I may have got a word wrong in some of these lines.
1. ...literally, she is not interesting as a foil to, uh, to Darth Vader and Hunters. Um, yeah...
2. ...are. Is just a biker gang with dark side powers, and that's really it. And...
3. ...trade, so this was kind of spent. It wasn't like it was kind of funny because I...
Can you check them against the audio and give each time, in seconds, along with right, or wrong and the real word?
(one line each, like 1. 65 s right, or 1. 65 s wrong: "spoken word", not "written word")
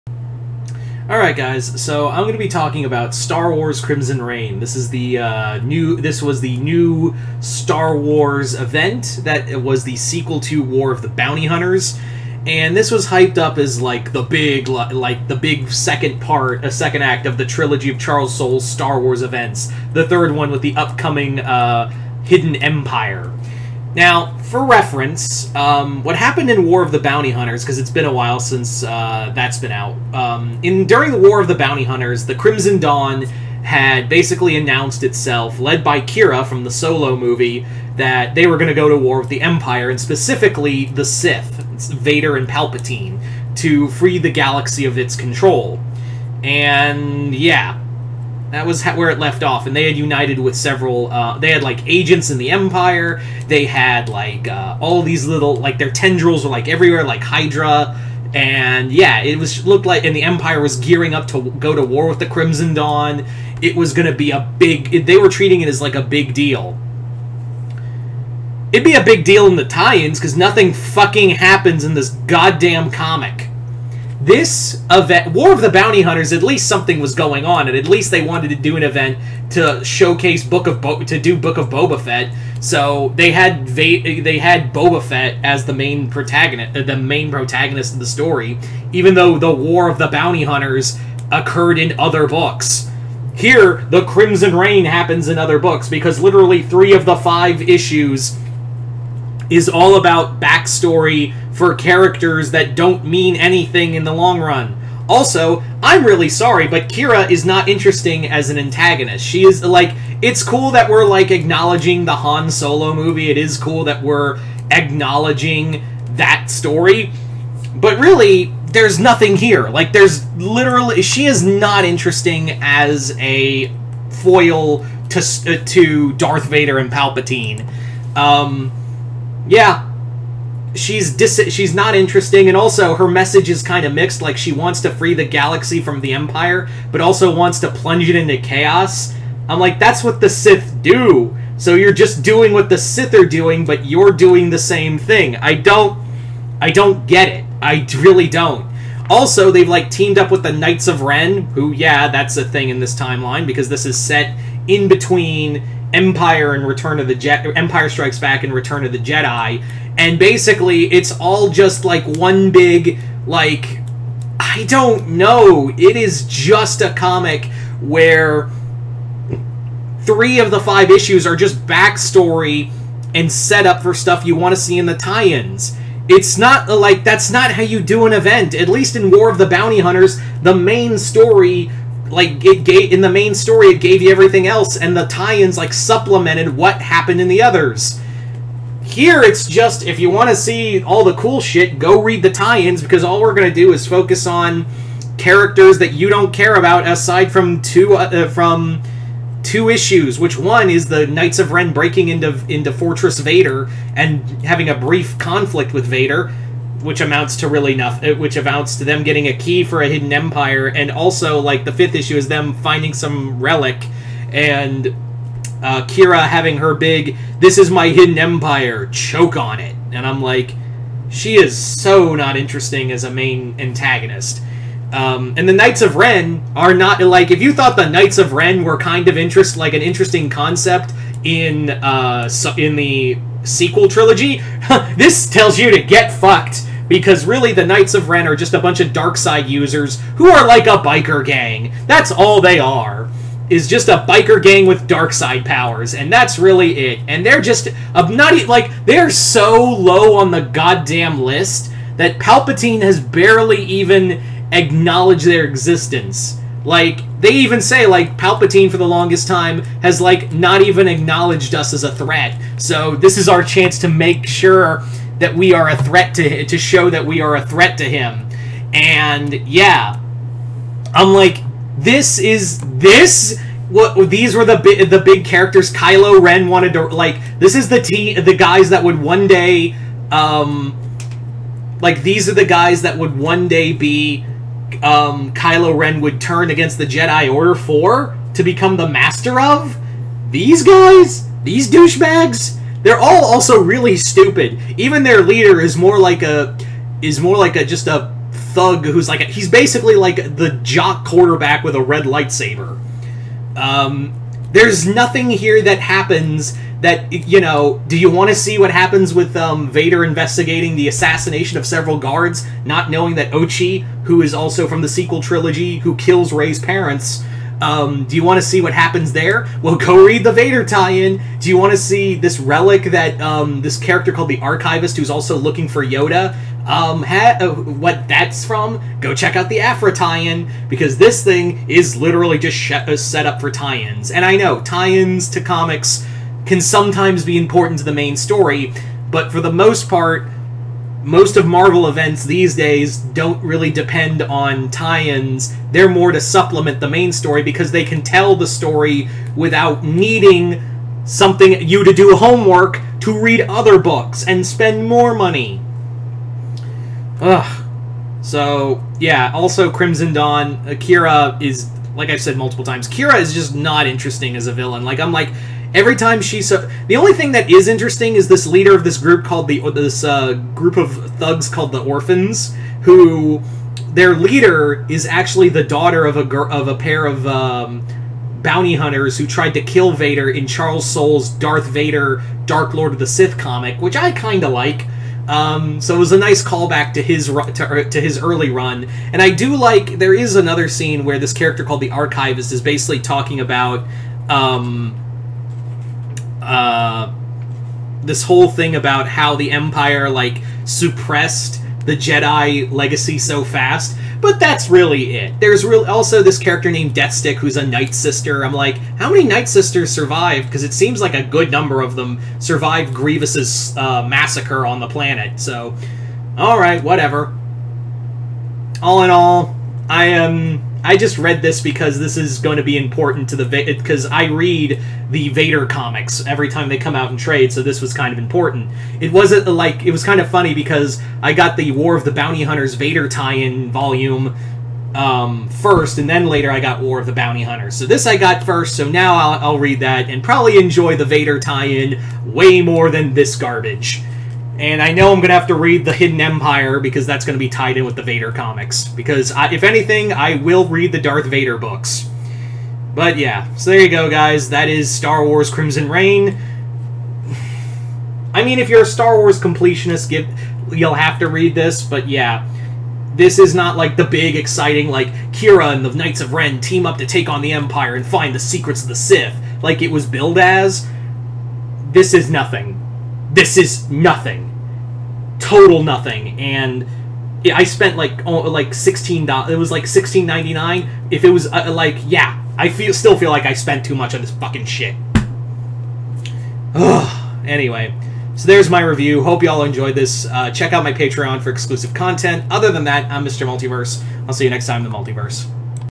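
1. 120 s wrong: "Palpatine", not "Hunters"
2. 242 s right
3. 427 s wrong: "important", not "spent".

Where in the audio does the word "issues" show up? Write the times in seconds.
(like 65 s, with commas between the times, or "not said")
97 s, 170 s, 199 s, 211 s.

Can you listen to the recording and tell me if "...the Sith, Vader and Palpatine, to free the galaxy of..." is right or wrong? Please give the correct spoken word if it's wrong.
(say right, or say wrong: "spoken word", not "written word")
right.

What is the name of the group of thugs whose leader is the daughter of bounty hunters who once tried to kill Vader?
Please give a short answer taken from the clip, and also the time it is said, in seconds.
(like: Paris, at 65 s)
the Orphans, at 371 s.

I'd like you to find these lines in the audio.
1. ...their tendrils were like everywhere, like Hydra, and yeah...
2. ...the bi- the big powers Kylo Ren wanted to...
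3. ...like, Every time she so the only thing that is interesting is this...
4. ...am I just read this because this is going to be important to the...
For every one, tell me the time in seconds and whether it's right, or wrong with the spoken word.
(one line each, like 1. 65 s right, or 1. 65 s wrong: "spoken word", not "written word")
1. 55 s right
2. 274 s wrong: "characters", not "powers"
3. 365 s right
4. 420 s right.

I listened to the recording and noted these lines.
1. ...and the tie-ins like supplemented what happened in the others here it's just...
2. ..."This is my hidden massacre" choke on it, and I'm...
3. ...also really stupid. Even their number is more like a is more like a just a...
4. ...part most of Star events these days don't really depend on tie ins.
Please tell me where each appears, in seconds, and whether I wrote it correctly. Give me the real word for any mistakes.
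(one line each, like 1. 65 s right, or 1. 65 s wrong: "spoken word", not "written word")
1. 184 s right
2. 217 s wrong: "empire", not "massacre"
3. 293 s wrong: "leader", not "number"
4. 339 s wrong: "Marvel", not "Star".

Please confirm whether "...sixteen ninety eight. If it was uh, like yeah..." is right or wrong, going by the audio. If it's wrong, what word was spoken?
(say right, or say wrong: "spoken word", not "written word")
wrong: "nine", not "eight".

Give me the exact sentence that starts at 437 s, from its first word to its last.
So this I got first, so now I'll, I'll read that and probably enjoy the Vader tie-in way more than this garbage.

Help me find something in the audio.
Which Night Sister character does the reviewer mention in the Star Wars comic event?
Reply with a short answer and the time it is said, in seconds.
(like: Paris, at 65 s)
Deathstick, at 406 s.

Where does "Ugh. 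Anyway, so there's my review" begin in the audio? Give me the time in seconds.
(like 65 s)
486 s.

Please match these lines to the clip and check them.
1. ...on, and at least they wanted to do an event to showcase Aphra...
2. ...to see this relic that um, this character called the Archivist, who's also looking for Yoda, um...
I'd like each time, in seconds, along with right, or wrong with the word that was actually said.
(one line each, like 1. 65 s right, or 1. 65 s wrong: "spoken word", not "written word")
1. 77 s wrong: "Book", not "Aphra"
2. 321 s right.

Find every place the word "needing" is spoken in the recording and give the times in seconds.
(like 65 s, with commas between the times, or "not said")
349 s.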